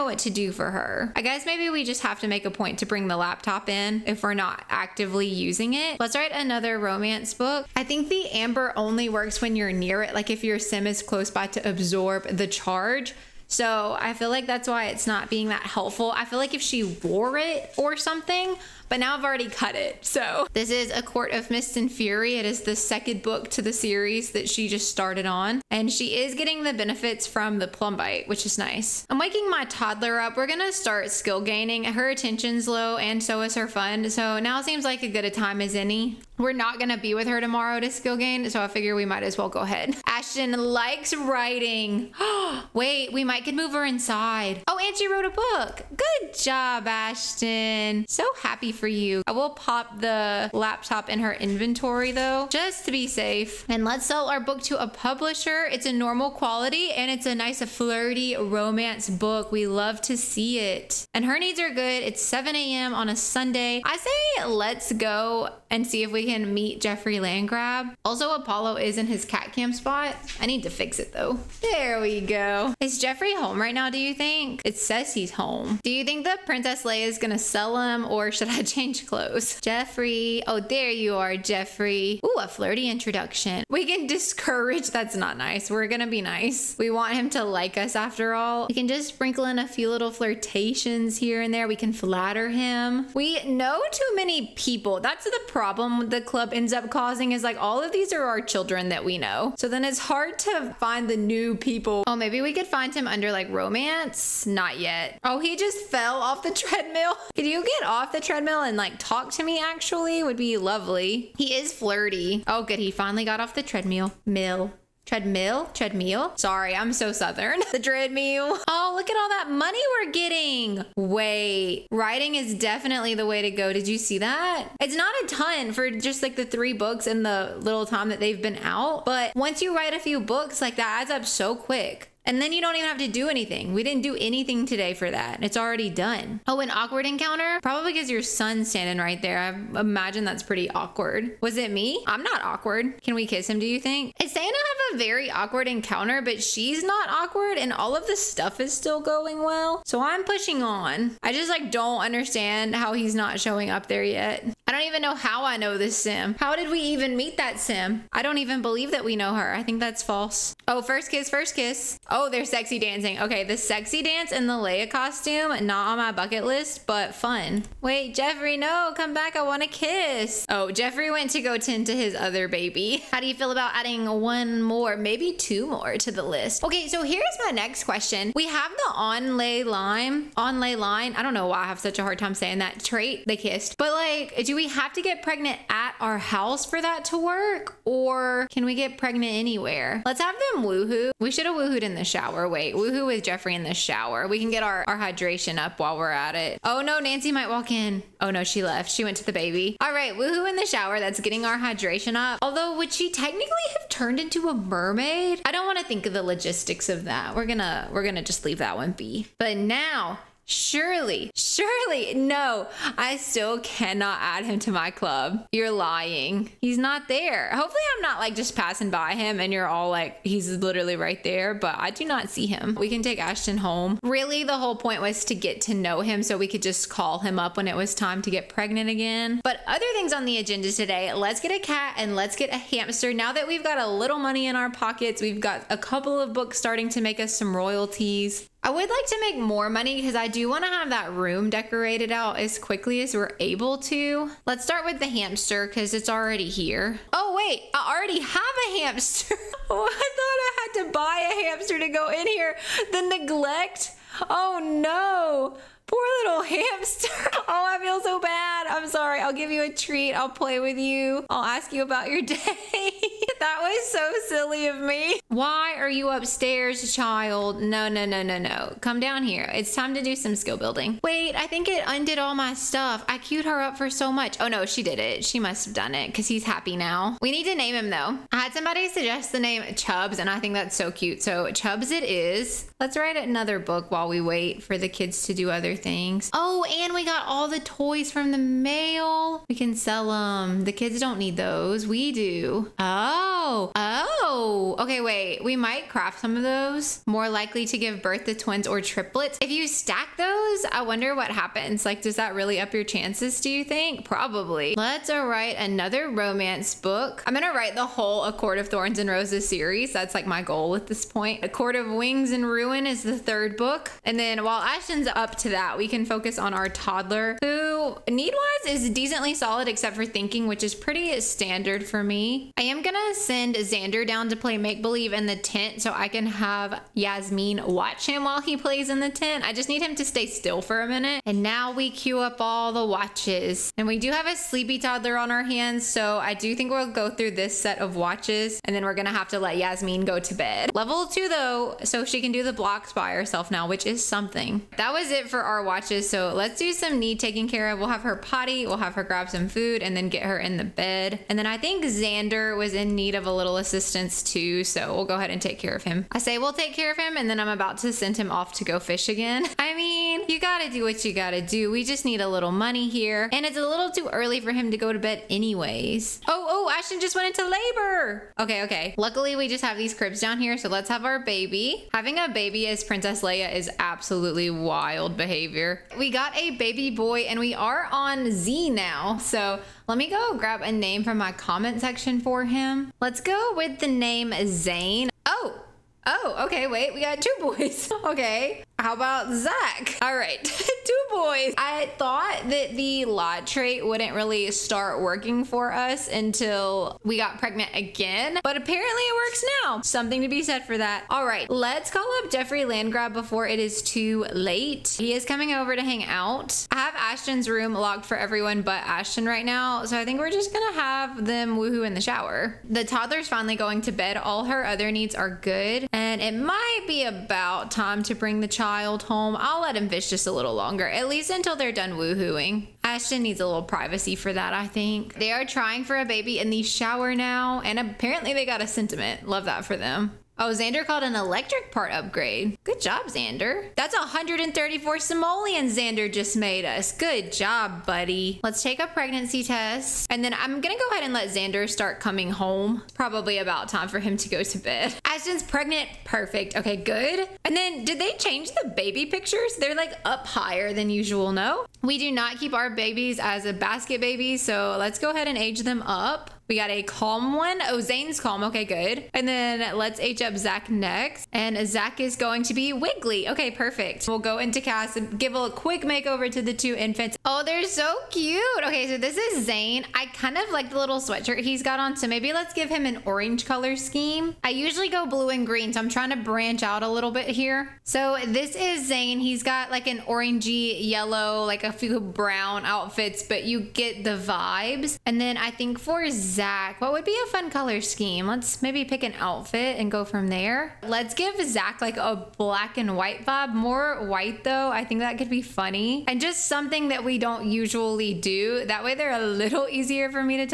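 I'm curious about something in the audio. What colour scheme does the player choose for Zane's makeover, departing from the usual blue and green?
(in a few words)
orange.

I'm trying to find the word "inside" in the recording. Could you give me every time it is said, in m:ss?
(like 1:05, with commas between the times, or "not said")
0:43.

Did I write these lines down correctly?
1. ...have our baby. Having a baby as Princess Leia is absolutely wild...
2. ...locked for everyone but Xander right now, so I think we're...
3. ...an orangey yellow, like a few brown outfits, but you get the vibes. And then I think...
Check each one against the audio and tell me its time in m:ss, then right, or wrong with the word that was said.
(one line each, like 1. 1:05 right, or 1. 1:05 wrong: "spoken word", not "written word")
1. 6:10 right
2. 6:47 wrong: "Ashton", not "Xander"
3. 7:59 right.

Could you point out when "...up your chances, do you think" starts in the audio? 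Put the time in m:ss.
5:02.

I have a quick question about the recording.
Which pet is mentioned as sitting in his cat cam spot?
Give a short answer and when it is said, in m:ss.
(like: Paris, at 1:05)
Apollo, at 1:08.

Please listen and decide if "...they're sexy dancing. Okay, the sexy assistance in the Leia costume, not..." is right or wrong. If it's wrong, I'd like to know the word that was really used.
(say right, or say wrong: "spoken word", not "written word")
wrong: "dance", not "assistance".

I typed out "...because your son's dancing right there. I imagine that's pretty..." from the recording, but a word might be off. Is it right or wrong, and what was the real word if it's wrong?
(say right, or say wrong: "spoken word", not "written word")
wrong: "standing", not "dancing".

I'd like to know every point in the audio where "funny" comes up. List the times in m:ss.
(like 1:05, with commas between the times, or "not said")
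8:15.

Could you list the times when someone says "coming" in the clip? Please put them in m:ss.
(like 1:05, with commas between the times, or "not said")
6:45, 7:22.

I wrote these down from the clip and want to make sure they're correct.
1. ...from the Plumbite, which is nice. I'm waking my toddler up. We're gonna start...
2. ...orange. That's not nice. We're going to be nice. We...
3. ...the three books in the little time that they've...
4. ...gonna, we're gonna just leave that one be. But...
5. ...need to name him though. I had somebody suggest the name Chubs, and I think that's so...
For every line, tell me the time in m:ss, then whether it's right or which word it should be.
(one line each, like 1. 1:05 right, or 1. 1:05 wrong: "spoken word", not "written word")
1. 0:27 right
2. 1:24 wrong: "discourage", not "orange"
3. 2:06 right
4. 3:27 right
5. 4:37 right.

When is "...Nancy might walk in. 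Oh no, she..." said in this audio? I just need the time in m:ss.
3:16.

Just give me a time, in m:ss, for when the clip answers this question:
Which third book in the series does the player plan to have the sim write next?
5:11.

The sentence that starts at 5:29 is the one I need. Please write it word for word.
I just need him to stay still for a minute.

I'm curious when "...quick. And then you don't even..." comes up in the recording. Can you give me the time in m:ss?
2:11.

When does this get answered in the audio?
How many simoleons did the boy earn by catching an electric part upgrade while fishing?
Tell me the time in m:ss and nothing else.
7:13.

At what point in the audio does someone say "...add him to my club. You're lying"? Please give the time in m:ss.
3:34.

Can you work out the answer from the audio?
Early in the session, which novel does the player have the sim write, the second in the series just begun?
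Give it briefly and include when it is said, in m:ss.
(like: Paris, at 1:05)
A Court of Mist and Fury, at 0:20.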